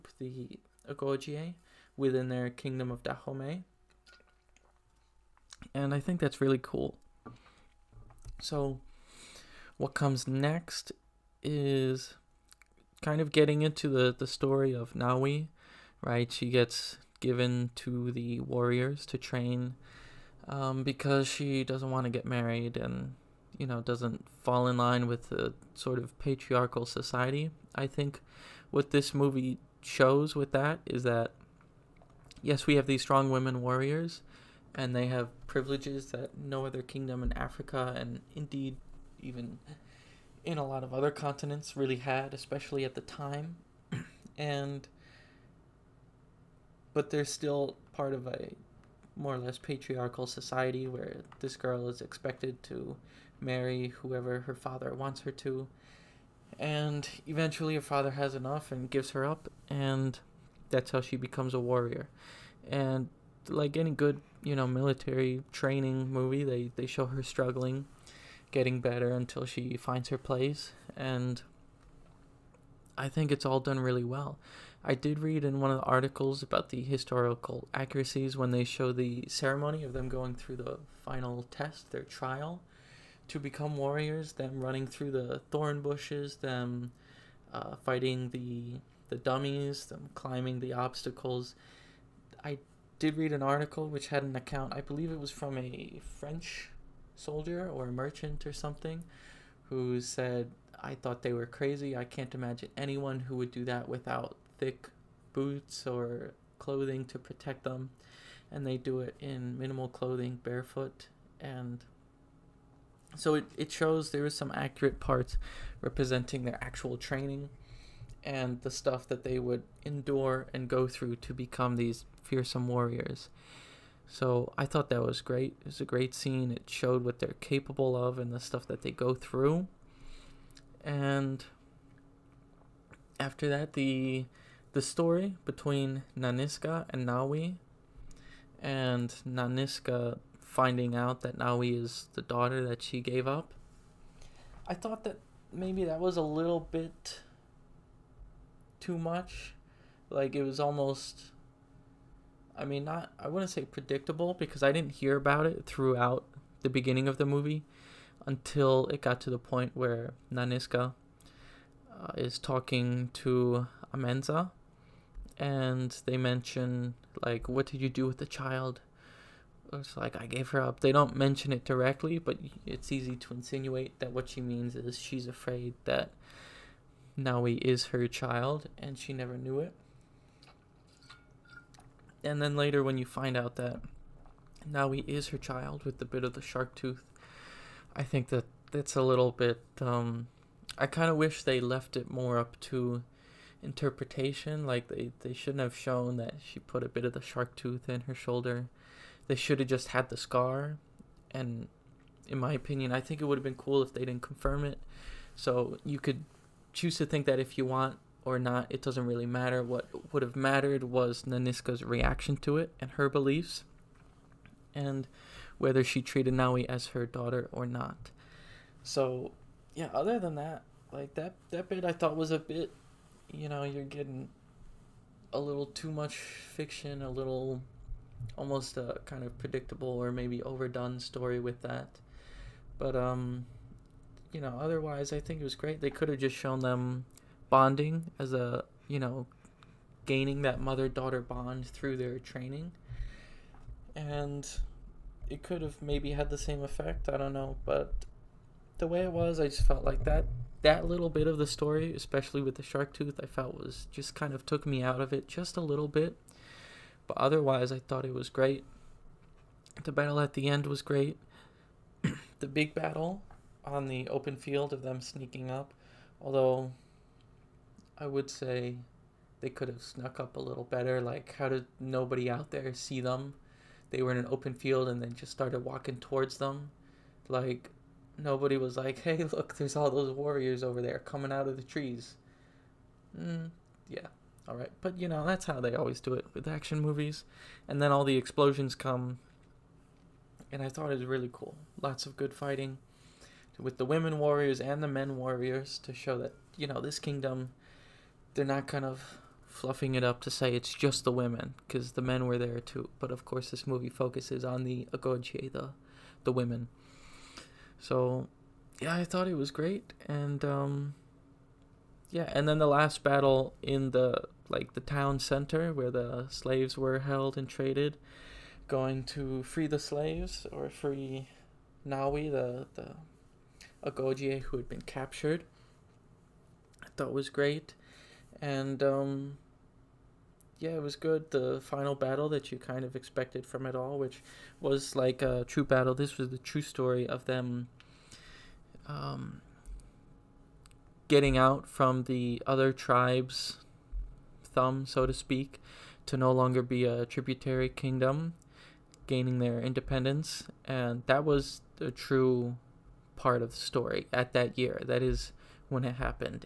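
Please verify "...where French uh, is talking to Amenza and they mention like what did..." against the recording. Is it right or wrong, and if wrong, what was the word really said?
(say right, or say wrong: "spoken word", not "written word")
wrong: "Nanisca", not "French".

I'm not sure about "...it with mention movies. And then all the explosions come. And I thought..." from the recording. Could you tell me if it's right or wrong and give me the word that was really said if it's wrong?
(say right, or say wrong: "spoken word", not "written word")
wrong: "action", not "mention".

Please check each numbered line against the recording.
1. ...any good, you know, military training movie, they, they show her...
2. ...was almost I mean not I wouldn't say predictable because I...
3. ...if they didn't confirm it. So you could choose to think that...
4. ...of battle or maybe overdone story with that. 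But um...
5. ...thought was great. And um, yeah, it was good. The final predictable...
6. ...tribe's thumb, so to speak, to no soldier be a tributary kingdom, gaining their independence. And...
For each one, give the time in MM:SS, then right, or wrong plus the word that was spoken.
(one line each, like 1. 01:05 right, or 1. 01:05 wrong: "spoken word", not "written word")
1. 01:03 right
2. 02:30 right
3. 03:23 right
4. 03:49 wrong: "predictable", not "battle"
5. 05:26 wrong: "battle", not "predictable"
6. 05:42 wrong: "longer", not "soldier".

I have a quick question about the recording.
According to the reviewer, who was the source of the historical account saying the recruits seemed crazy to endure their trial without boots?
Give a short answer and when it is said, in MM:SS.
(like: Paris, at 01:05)
A French soldier, at 01:35.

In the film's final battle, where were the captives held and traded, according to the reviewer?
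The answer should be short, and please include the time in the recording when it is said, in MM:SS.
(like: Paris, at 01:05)
The town center, at 05:14.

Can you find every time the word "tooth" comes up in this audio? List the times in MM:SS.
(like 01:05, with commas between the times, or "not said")
03:06, 03:17, 04:12.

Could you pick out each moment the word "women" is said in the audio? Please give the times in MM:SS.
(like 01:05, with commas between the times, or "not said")
00:33, 04:53, 05:01, 05:06.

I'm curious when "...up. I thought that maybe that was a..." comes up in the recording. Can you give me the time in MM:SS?
02:23.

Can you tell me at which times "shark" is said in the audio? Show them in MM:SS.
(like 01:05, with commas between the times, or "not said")
03:06, 03:17, 04:12.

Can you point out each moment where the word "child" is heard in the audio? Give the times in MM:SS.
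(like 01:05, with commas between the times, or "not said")
02:48, 02:58, 03:05.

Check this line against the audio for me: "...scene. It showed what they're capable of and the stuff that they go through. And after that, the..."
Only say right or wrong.
right.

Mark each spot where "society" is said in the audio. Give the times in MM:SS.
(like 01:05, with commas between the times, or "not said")
00:26, 00:50.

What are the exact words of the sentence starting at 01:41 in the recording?
I can't imagine anyone who would do that without thick boots or clothing to protect them.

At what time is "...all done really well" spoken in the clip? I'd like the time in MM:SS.
01:13.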